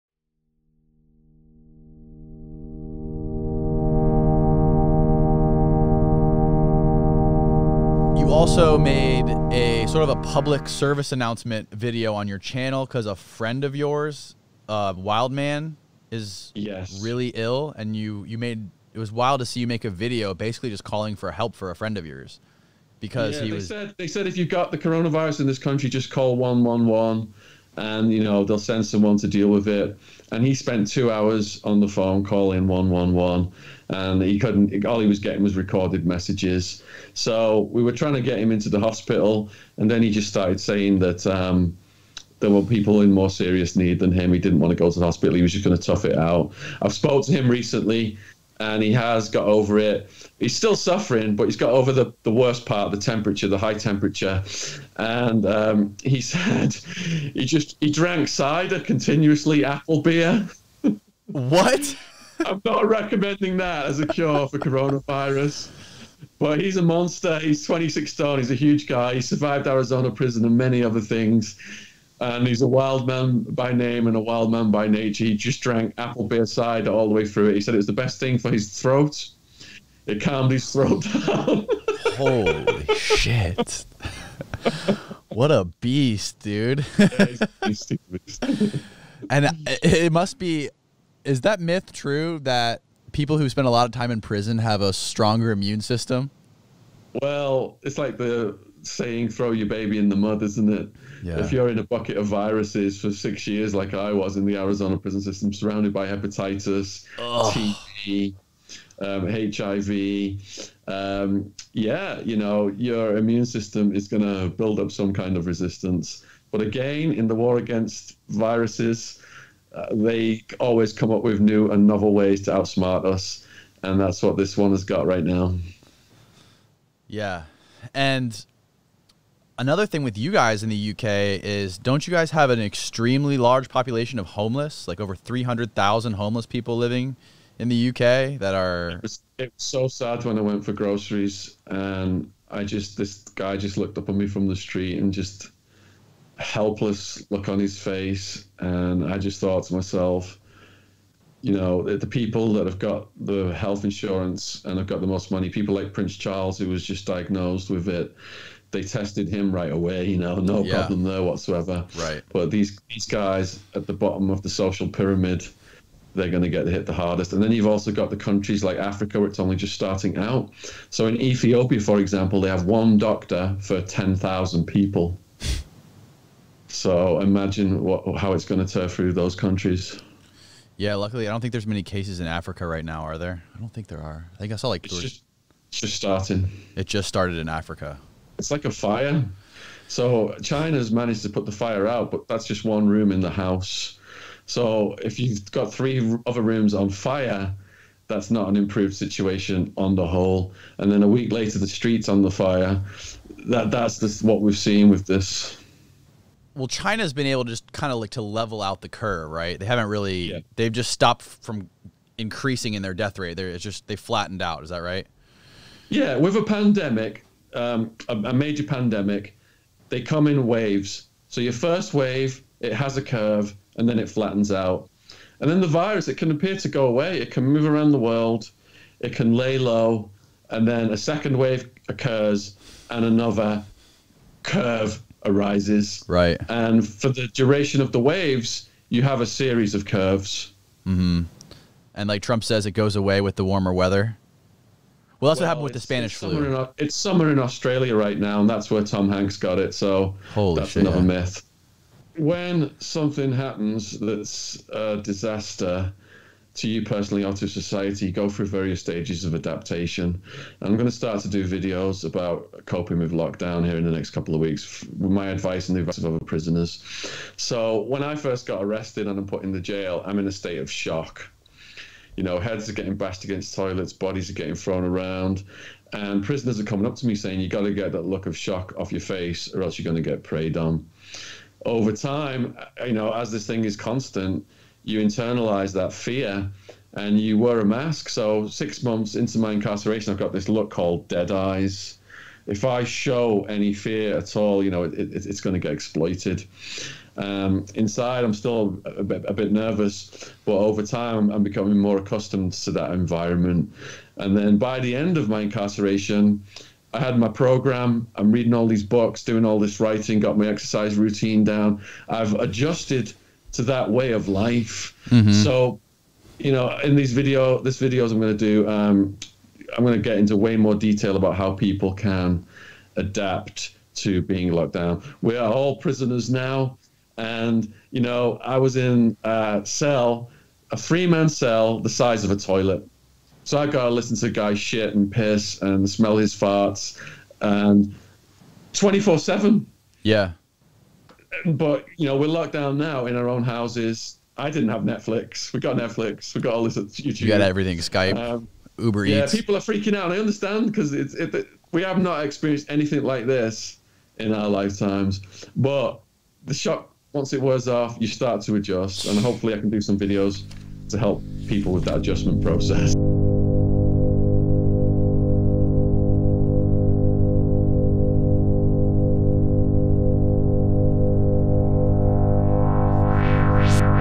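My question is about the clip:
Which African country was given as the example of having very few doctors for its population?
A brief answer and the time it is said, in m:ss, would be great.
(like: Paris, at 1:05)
Ethiopia, at 2:51.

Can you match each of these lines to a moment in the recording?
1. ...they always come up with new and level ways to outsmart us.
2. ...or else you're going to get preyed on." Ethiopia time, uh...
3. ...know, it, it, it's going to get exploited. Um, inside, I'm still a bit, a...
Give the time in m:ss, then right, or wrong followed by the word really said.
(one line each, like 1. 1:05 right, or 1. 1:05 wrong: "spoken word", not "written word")
1. 1:59 wrong: "novel", not "level"
2. 4:39 wrong: "Over", not "Ethiopia"
3. 4:54 right.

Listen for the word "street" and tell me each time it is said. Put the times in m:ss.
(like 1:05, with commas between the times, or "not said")
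2:24, 3:21.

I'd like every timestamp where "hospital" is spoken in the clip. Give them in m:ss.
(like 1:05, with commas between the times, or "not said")
0:38, 0:45.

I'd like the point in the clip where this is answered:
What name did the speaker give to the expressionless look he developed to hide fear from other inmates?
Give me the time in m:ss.
4:51.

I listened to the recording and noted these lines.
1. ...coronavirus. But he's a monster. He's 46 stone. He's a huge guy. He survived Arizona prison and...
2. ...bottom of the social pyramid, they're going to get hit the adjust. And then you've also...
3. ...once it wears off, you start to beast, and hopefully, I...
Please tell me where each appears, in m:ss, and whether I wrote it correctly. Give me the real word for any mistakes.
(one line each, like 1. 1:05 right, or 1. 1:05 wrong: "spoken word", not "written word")
1. 1:04 wrong: "26", not "46"
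2. 2:43 wrong: "hardest", not "adjust"
3. 5:57 wrong: "adjust", not "beast".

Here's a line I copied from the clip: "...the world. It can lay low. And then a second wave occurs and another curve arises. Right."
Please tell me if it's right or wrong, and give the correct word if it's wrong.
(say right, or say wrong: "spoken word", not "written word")
right.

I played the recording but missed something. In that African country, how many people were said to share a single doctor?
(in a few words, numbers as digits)
10,000.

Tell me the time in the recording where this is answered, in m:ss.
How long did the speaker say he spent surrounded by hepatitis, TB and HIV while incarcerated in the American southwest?
1:43.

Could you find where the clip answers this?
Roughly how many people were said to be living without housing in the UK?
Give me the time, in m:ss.
2:15.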